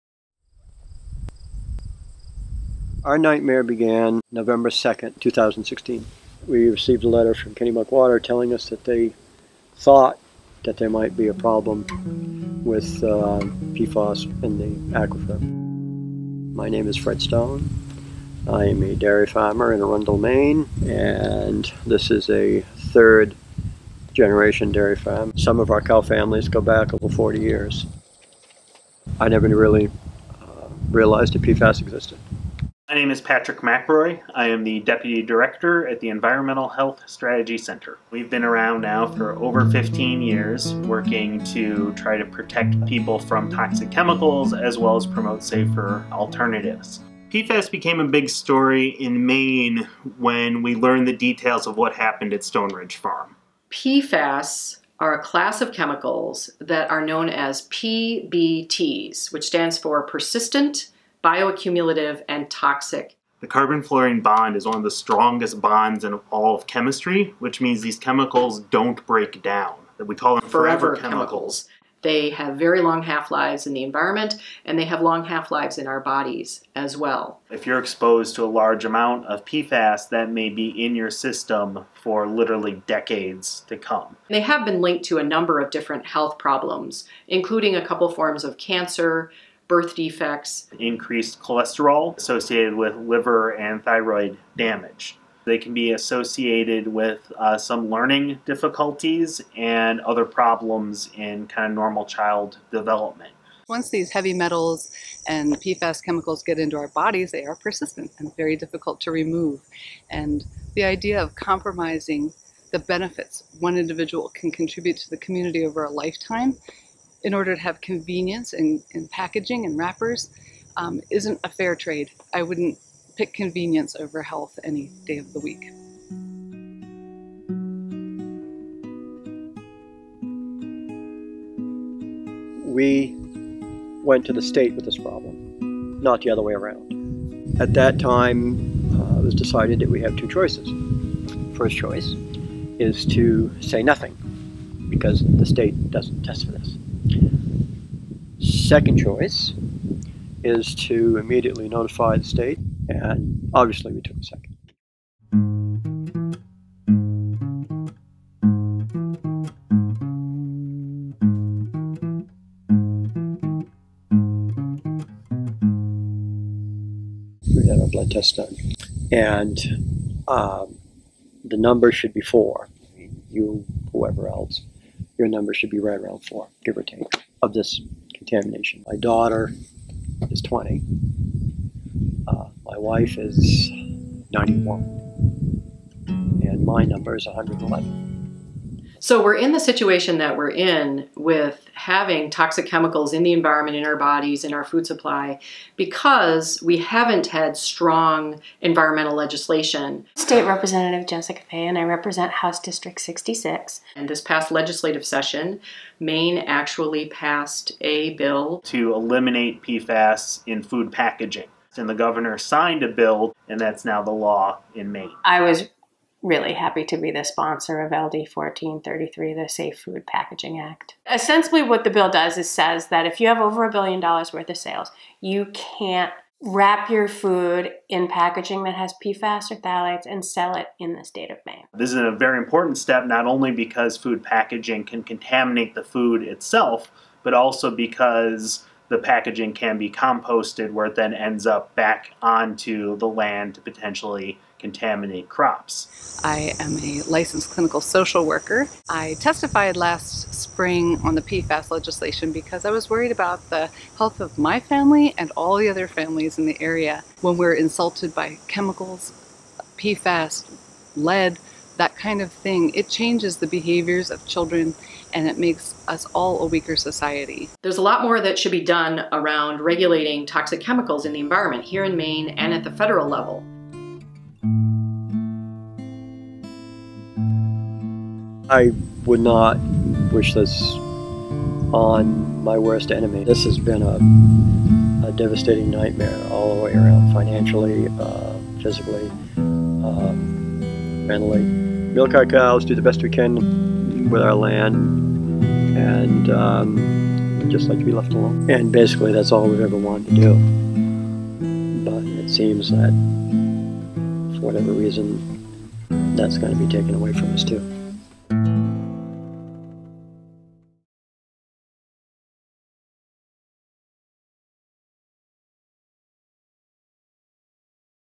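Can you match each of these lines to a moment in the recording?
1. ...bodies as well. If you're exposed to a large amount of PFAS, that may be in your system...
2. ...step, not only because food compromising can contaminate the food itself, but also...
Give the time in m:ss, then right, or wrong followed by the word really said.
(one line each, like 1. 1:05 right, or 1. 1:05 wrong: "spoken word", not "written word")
1. 1:15 right
2. 3:52 wrong: "packaging", not "compromising".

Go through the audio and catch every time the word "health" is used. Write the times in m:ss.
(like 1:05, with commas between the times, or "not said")
0:36, 1:26, 2:04, 4:13.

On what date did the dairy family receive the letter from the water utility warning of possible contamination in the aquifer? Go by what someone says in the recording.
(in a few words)
November 2nd, 2016.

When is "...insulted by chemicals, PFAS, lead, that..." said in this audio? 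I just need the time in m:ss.
4:17.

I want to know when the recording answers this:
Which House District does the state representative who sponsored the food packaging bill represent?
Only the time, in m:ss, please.
3:23.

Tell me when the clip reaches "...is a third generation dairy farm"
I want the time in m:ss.
0:22.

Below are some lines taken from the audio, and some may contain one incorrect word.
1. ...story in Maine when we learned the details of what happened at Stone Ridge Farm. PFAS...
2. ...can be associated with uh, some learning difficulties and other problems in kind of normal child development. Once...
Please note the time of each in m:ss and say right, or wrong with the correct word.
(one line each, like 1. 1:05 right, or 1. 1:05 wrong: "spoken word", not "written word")
1. 0:48 right
2. 1:35 right.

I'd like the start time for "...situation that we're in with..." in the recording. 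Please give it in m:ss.
3:09.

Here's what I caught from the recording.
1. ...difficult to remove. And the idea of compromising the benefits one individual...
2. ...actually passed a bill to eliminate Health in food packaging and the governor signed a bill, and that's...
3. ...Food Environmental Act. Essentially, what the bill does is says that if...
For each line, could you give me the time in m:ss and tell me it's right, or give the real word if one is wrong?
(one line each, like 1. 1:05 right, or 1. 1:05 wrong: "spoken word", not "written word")
1. 1:48 right
2. 3:26 wrong: "PFAS", not "Health"
3. 3:39 wrong: "Packaging", not "Environmental".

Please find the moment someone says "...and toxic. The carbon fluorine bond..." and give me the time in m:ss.
1:02.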